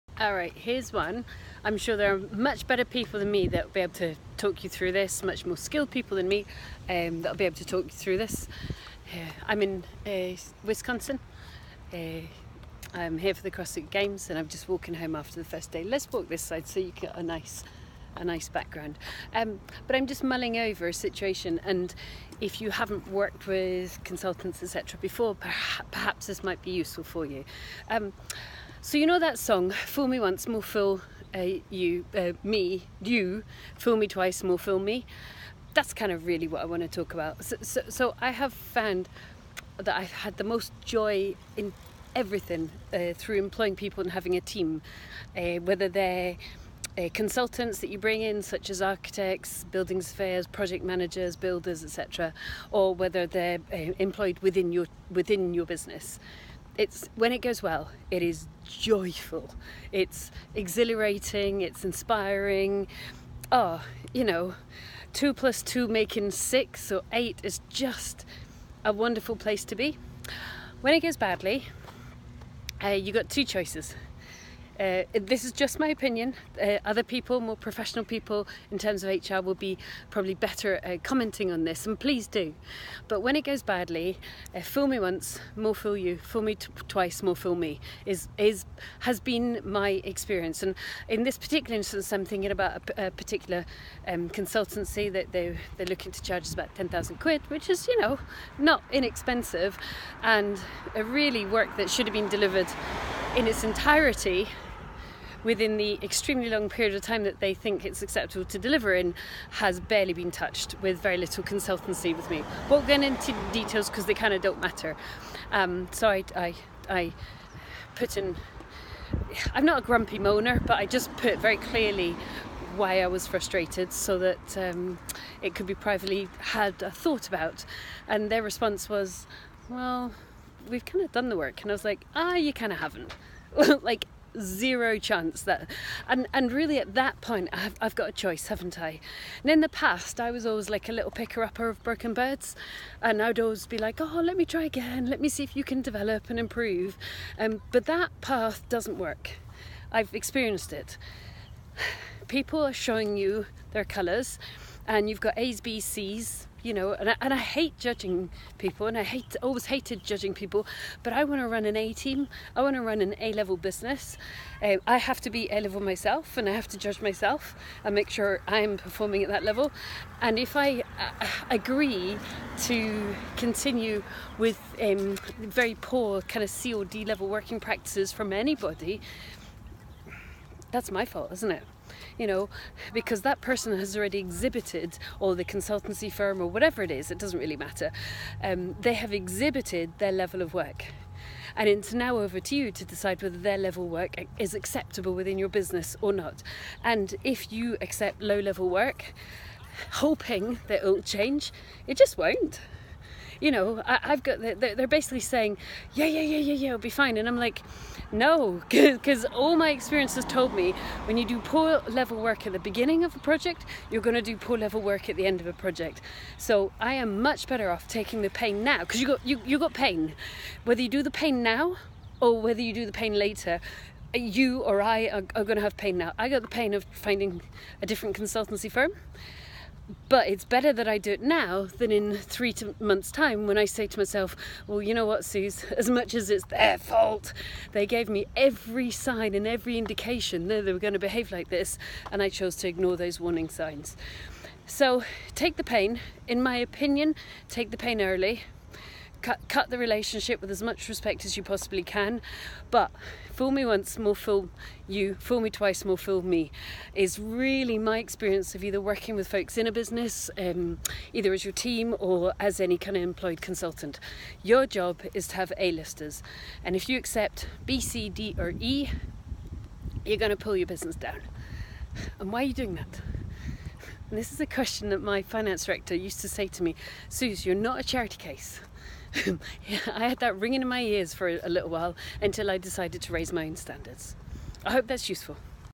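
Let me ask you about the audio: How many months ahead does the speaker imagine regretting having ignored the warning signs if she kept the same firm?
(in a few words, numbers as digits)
3.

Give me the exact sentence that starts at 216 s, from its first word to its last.
So I am much better off taking the pain now because you got, you, you got pain.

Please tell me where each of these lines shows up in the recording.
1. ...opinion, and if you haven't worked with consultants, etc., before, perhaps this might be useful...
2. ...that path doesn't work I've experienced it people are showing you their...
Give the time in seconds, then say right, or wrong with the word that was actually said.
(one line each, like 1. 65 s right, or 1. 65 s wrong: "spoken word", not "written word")
1. 20 s wrong: "situation", not "opinion"
2. 147 s right.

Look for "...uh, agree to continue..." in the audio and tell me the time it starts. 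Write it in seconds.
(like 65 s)
170 s.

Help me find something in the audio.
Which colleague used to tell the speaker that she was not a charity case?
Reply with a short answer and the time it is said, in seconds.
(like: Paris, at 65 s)
Finance director, at 275 s.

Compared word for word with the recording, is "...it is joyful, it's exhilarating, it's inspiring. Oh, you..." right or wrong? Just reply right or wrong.
right.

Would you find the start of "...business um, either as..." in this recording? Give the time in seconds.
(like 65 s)
259 s.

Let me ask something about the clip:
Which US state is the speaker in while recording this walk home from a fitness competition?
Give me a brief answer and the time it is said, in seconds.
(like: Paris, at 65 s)
Wisconsin, at 10 s.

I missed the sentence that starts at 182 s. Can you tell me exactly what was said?
You know, because that person has already exhibited, or the consultancy firm, or whatever it is, it doesn't really matter.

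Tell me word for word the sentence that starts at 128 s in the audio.
And their response was, well, we've kind of done the work.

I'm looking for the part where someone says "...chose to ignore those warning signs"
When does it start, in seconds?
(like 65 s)
242 s.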